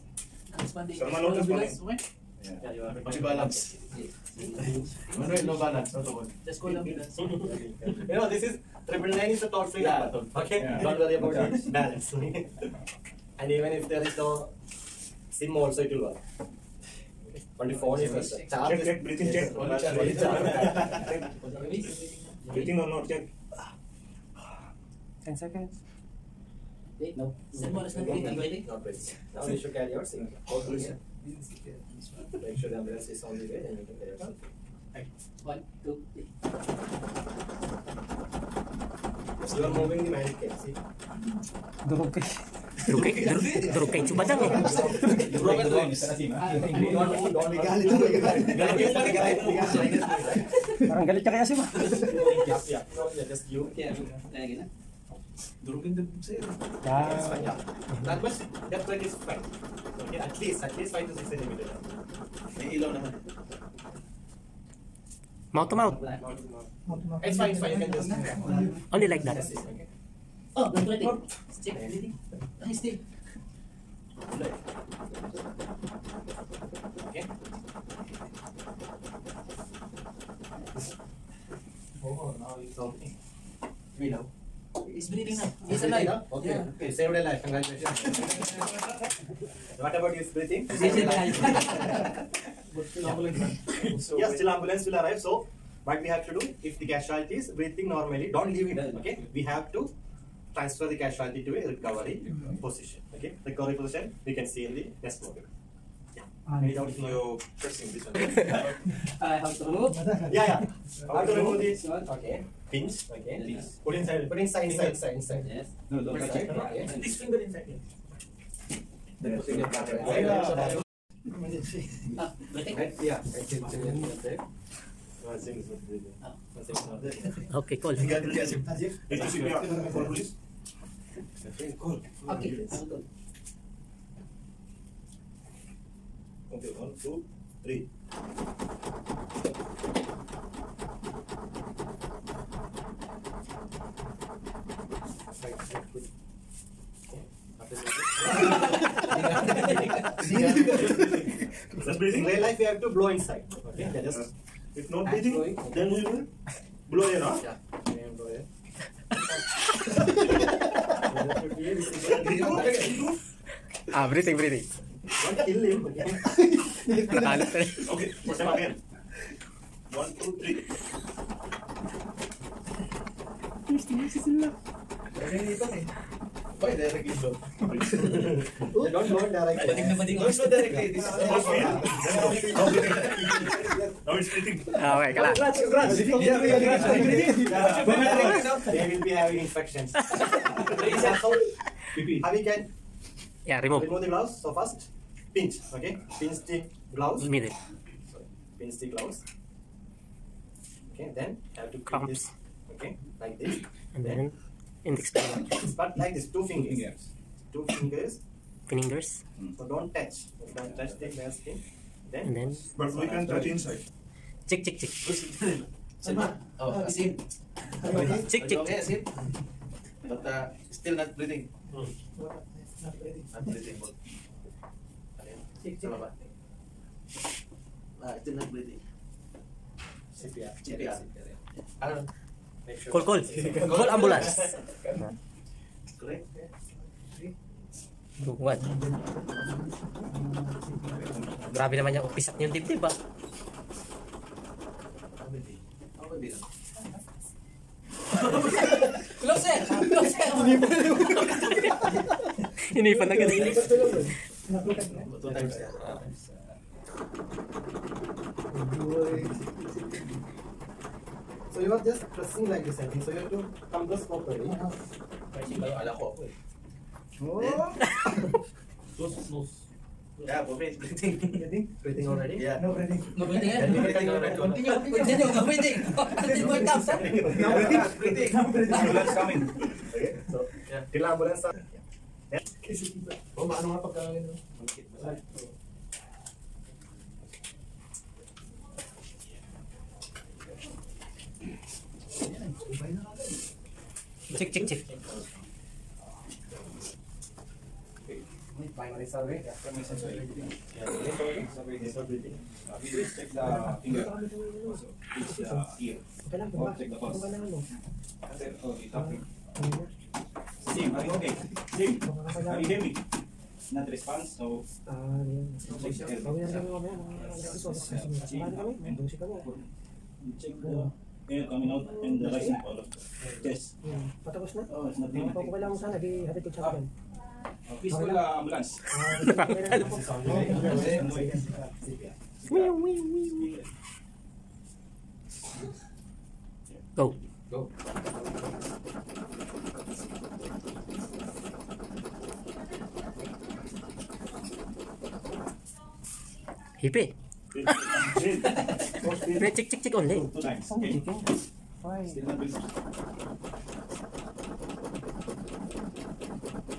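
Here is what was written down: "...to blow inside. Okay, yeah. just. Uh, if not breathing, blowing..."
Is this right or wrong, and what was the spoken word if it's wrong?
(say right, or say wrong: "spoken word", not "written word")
right.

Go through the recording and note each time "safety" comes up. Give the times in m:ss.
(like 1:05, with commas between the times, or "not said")
0:30, 0:34.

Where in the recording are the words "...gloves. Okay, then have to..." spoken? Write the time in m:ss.
3:18.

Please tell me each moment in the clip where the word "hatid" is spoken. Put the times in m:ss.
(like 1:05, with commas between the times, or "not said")
5:26.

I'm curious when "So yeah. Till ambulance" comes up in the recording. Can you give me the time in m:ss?
4:40.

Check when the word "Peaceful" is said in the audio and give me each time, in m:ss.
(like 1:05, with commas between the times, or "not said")
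5:27.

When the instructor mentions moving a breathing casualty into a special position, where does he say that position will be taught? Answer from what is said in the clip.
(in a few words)
In the next module.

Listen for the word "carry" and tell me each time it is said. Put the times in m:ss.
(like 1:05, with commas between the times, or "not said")
0:29, 0:33.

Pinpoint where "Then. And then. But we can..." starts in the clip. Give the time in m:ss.
3:32.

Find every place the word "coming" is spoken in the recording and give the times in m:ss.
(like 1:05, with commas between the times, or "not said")
4:39, 5:21.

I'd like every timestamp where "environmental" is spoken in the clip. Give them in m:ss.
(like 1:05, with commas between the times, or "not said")
not said.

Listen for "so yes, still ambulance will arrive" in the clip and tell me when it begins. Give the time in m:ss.
1:34.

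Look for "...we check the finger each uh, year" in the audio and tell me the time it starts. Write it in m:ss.
5:02.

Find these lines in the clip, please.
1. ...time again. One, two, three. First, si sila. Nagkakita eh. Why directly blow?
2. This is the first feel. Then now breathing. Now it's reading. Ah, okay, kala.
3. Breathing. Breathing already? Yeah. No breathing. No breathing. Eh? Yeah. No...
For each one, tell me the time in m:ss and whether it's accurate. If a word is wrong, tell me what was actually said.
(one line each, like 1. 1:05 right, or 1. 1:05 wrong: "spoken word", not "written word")
1. 2:48 right
2. 3:00 wrong: "breathing", not "reading"
3. 4:31 right.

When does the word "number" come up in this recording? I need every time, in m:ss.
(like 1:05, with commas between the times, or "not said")
0:10.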